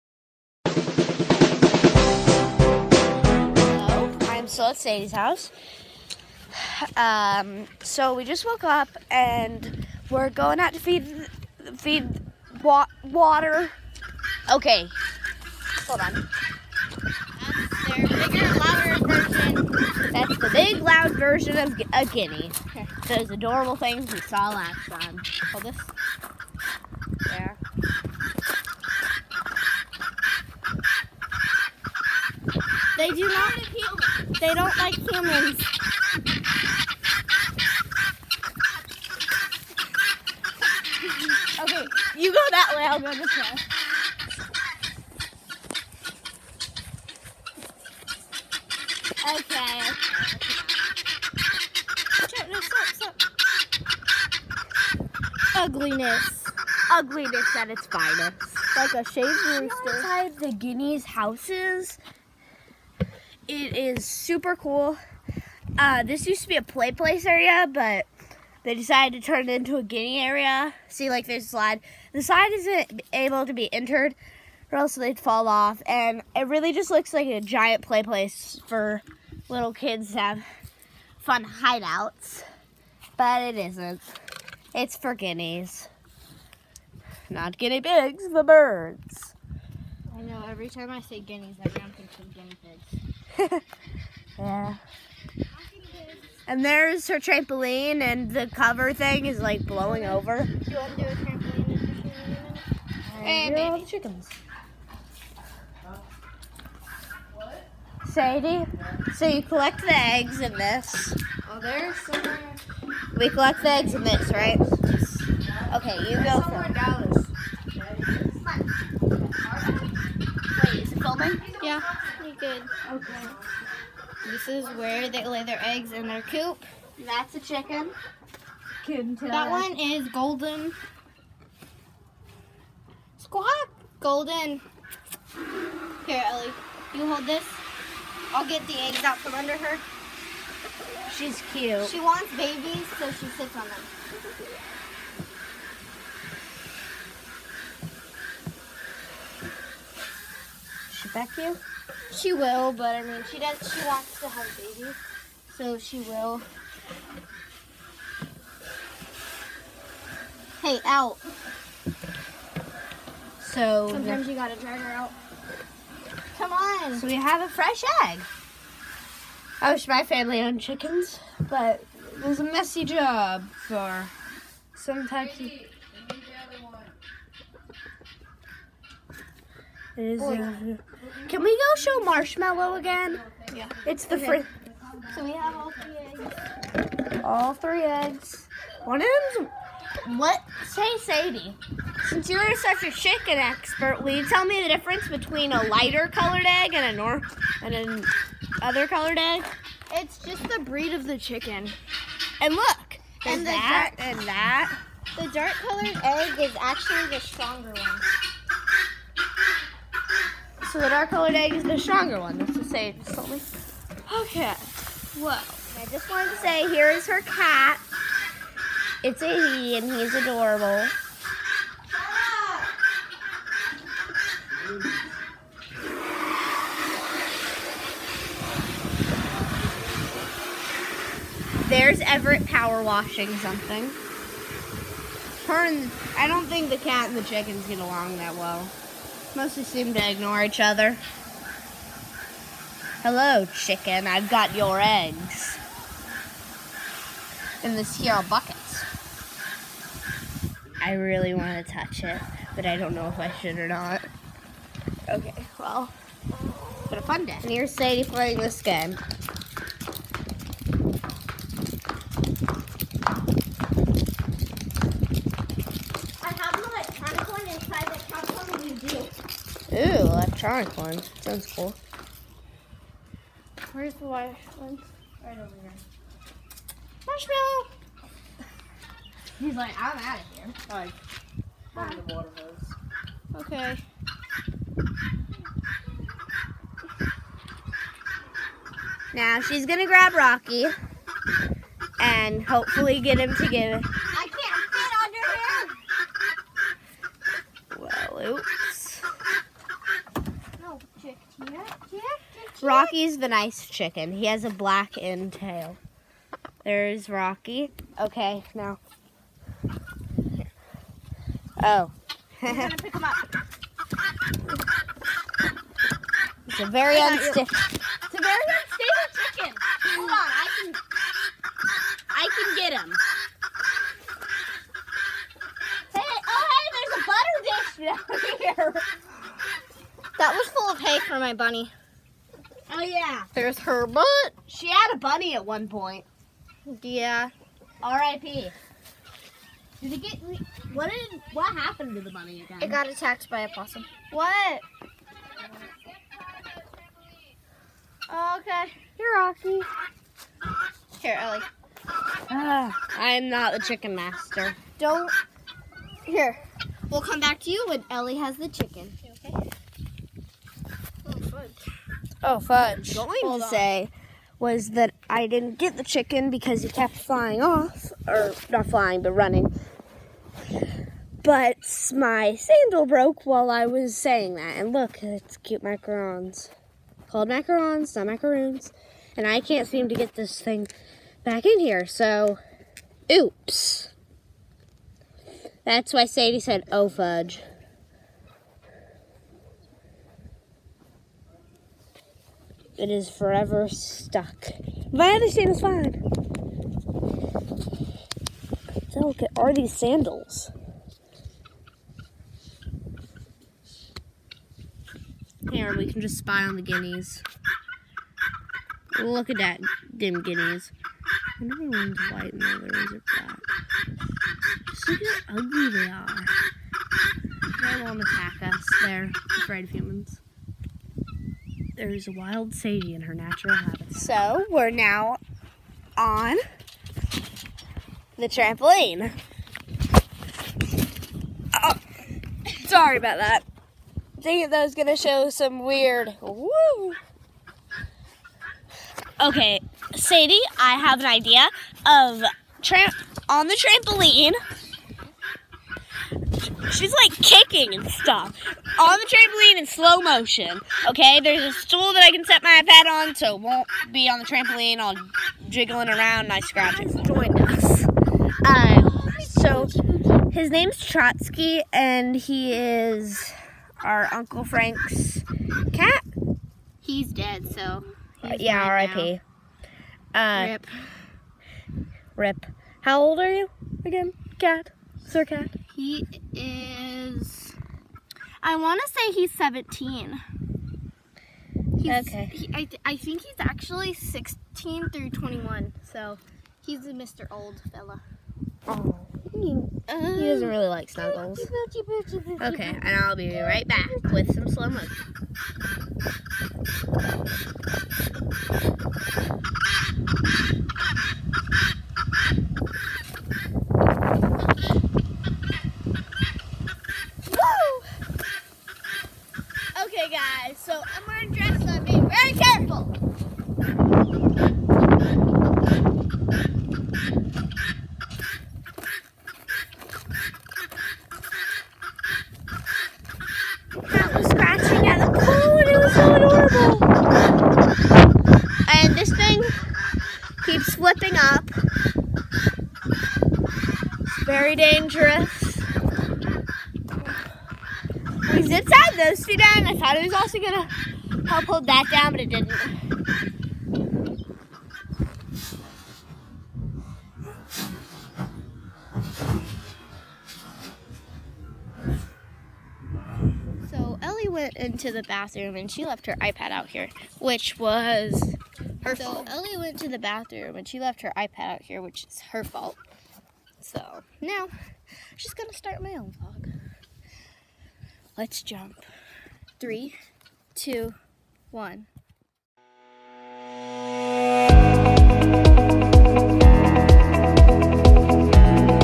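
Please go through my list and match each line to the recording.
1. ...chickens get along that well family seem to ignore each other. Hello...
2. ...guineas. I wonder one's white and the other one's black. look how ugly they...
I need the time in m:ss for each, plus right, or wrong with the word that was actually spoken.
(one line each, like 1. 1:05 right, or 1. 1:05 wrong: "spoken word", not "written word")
1. 3:57 wrong: "mostly", not "family"
2. 6:50 right.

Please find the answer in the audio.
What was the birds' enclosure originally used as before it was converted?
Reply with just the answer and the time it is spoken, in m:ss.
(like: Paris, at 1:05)
play place area, at 1:06.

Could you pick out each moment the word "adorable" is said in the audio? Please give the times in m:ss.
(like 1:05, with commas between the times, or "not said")
0:23, 3:40, 8:46.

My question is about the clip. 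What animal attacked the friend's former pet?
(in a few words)
a possum.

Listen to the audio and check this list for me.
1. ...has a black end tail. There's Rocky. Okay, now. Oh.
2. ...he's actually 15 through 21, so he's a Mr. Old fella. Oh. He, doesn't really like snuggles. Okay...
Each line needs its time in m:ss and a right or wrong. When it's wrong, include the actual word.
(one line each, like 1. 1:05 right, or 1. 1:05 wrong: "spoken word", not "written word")
1. 5:04 right
2. 8:03 wrong: "16", not "15".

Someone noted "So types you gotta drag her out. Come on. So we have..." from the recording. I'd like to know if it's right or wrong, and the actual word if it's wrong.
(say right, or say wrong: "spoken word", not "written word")
wrong: "sometimes", not "types".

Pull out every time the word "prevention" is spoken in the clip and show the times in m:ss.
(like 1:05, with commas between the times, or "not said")
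not said.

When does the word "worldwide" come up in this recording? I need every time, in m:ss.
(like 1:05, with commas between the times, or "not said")
not said.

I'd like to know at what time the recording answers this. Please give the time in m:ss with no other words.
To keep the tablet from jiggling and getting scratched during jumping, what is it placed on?
7:31.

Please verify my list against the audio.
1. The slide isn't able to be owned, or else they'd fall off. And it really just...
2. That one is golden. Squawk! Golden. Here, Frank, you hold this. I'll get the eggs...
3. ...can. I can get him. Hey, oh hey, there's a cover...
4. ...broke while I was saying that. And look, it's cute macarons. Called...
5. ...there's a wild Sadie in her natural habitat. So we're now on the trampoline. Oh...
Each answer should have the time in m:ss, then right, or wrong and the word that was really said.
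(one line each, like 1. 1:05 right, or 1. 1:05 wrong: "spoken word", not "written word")
1. 1:12 wrong: "entered", not "owned"
2. 2:09 wrong: "Ellie", not "Frank"
3. 5:20 wrong: "butter", not "cover"
4. 6:12 right
5. 7:01 right.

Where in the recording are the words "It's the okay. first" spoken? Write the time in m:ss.
3:03.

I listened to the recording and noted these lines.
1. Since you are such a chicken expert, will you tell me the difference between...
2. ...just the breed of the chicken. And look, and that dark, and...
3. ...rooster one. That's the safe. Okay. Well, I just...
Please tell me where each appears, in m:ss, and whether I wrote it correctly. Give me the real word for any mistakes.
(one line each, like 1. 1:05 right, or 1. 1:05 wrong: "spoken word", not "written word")
1. 3:12 right
2. 3:20 right
3. 3:31 wrong: "stronger", not "rooster".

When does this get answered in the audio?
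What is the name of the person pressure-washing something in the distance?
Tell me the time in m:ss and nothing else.
3:52.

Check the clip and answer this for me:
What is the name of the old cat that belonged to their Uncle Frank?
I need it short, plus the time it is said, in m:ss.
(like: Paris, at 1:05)
Trotsky, at 7:40.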